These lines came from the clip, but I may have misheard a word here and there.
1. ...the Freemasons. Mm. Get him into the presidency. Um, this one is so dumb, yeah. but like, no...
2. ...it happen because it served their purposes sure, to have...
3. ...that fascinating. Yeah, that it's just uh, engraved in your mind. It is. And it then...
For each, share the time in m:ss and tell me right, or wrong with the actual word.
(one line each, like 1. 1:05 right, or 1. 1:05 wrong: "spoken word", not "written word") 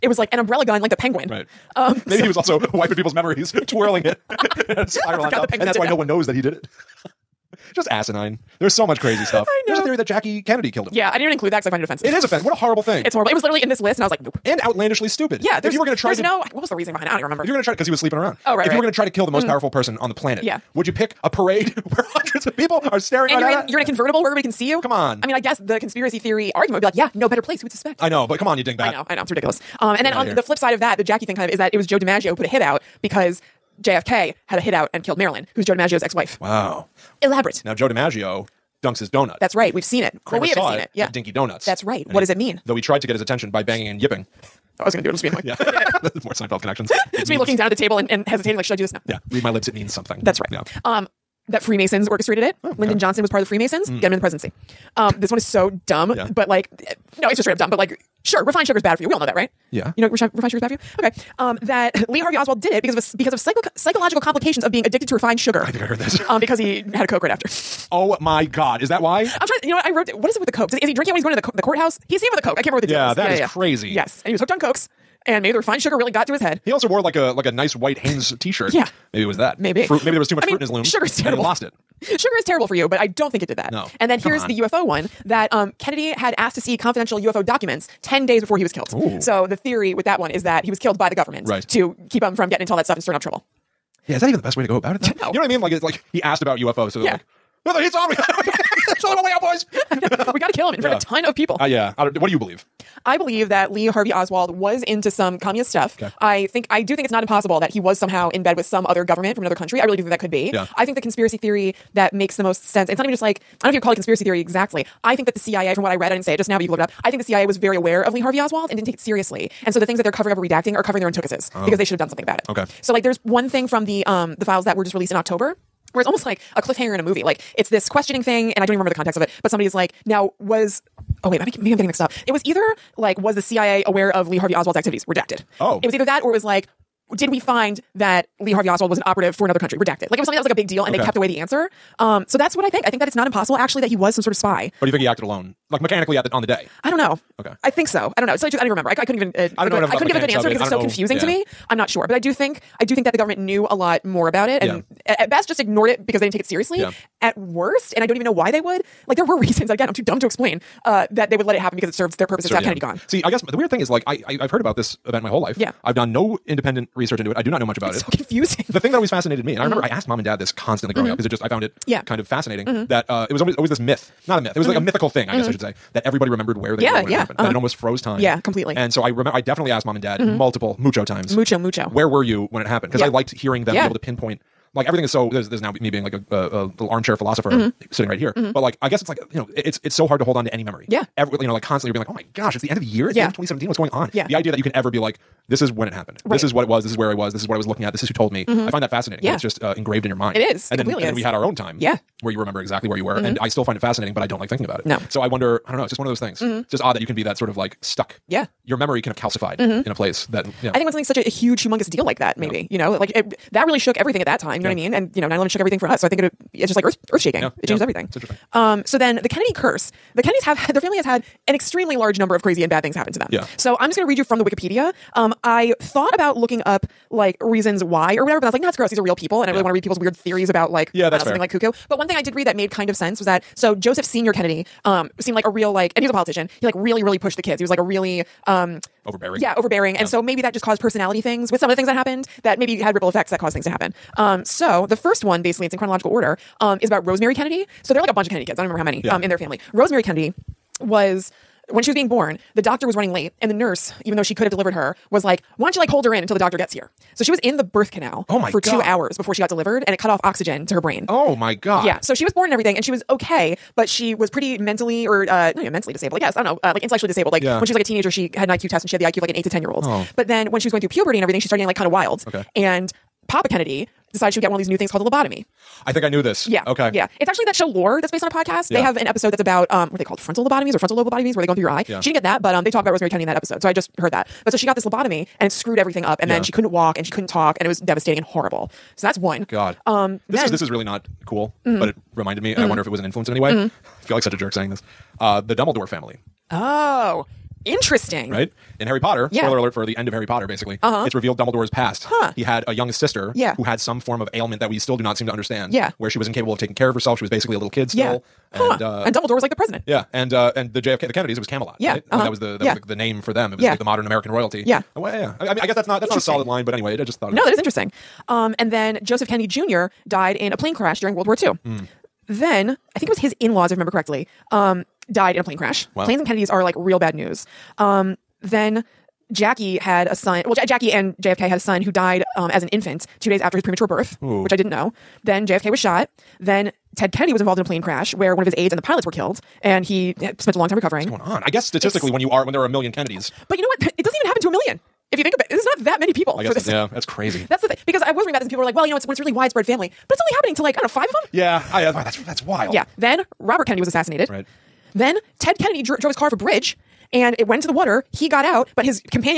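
1. 0:53 right
2. 2:41 right
3. 3:18 right.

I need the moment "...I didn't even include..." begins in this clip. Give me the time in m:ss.
0:11.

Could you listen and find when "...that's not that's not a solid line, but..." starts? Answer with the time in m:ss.
5:15.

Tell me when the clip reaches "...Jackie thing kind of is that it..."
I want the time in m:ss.
0:31.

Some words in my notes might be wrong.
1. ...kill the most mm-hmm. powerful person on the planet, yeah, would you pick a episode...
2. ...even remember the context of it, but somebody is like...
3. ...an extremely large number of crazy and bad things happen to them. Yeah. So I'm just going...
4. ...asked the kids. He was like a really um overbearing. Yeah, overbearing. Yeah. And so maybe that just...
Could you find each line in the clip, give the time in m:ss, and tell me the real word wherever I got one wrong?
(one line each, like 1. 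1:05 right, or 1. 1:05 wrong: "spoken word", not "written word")
1. 0:19 wrong: "parade", not "episode"
2. 2:08 right
3. 3:41 right
4. 3:57 wrong: "pushed", not "asked".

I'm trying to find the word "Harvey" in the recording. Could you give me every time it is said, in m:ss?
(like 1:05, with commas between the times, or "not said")
1:02, 1:43, 1:58, 2:14, 2:18.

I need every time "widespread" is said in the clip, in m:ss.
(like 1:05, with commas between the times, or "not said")
5:49.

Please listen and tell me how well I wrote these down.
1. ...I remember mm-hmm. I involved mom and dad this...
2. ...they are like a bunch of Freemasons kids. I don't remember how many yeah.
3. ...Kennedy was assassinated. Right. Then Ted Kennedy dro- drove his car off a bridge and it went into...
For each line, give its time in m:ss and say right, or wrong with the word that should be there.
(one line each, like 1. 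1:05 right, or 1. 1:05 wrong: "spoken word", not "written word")
1. 2:49 wrong: "asked", not "involved"
2. 4:07 wrong: "Kennedy", not "Freemasons"
3. 5:53 right.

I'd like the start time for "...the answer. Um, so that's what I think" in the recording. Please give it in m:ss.
2:21.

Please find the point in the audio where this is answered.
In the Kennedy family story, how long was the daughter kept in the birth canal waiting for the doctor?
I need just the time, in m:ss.
4:18.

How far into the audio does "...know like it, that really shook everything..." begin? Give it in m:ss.
3:32.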